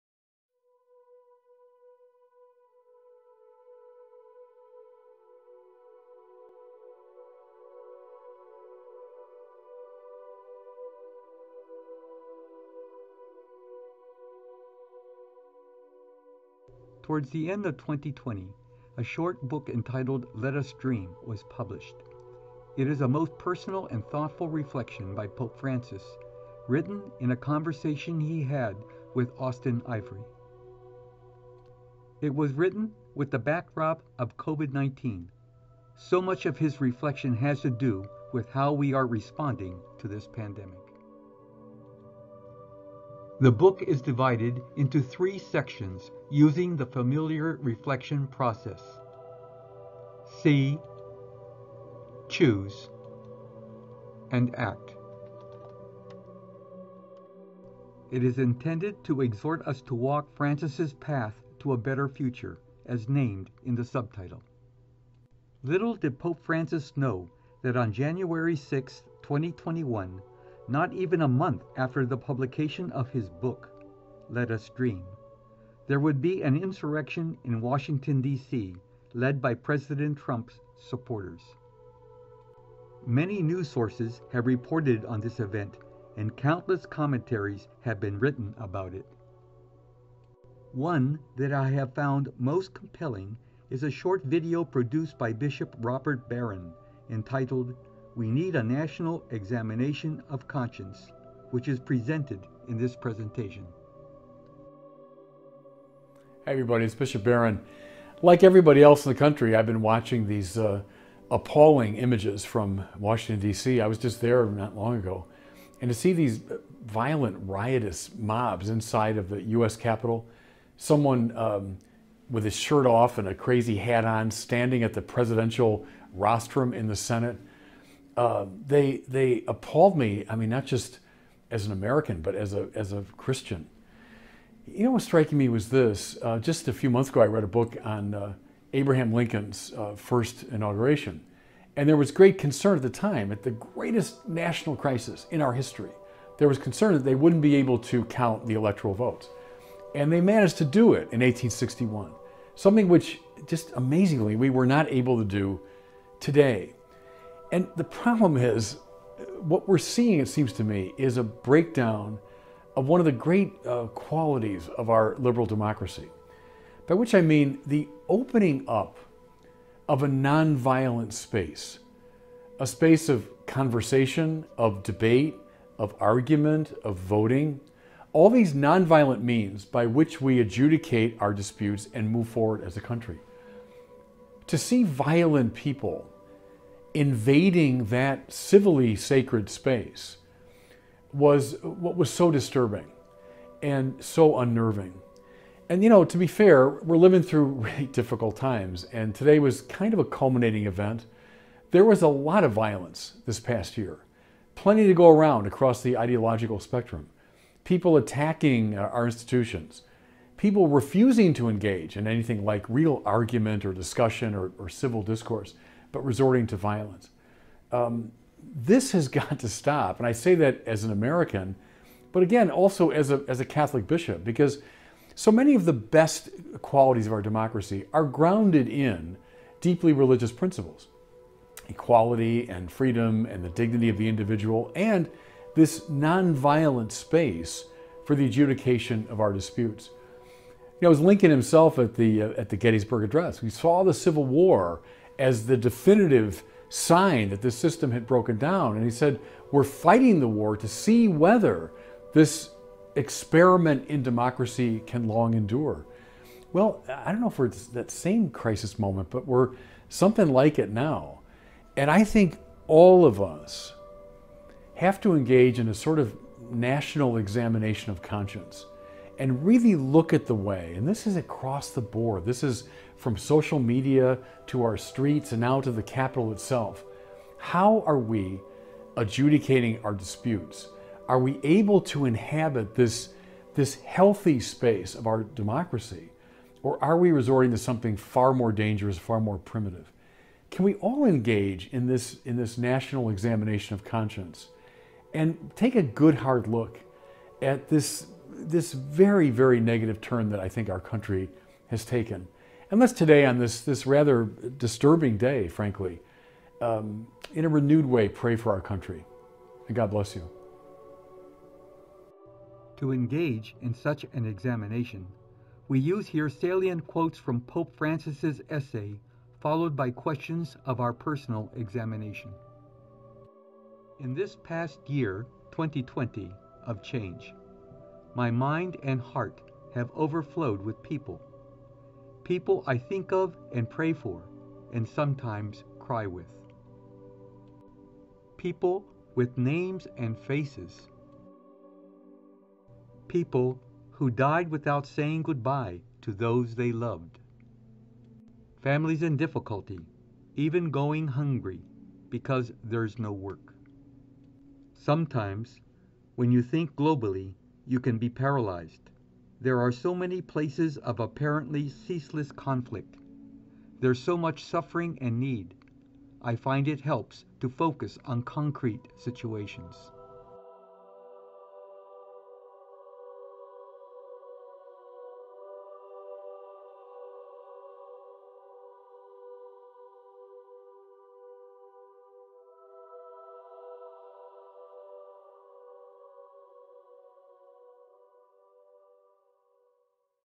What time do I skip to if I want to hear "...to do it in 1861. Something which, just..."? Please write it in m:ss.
2:30.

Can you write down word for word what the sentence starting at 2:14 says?
You know, what striking me was this.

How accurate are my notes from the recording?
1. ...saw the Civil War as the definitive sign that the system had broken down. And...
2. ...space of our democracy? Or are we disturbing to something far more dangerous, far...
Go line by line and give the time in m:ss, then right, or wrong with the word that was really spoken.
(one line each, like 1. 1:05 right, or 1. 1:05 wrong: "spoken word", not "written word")
1. 4:03 right
2. 4:44 wrong: "resorting", not "disturbing".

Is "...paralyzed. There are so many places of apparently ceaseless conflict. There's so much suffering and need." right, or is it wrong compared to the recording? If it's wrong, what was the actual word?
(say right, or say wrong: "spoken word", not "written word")
right.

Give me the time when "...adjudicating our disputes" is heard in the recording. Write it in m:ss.
4:38.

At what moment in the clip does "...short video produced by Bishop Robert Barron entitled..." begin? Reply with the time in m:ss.
1:33.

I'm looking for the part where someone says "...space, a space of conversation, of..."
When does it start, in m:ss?
2:51.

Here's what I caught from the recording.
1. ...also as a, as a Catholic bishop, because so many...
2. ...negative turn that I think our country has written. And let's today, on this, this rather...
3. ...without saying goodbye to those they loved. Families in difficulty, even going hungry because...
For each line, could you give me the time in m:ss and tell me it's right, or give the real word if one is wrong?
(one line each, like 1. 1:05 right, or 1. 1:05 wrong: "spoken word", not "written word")
1. 3:42 right
2. 4:59 wrong: "taken", not "written"
3. 5:44 right.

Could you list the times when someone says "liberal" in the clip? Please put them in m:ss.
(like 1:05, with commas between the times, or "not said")
2:45.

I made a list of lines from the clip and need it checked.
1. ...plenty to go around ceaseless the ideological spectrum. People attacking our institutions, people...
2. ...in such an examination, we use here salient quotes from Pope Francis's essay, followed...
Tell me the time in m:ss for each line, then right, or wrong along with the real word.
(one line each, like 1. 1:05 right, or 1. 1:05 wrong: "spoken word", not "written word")
1. 3:24 wrong: "across", not "ceaseless"
2. 5:13 right.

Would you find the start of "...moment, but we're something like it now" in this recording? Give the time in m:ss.
4:18.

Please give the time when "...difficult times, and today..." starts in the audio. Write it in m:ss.
3:17.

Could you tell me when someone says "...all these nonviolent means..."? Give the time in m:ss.
2:58.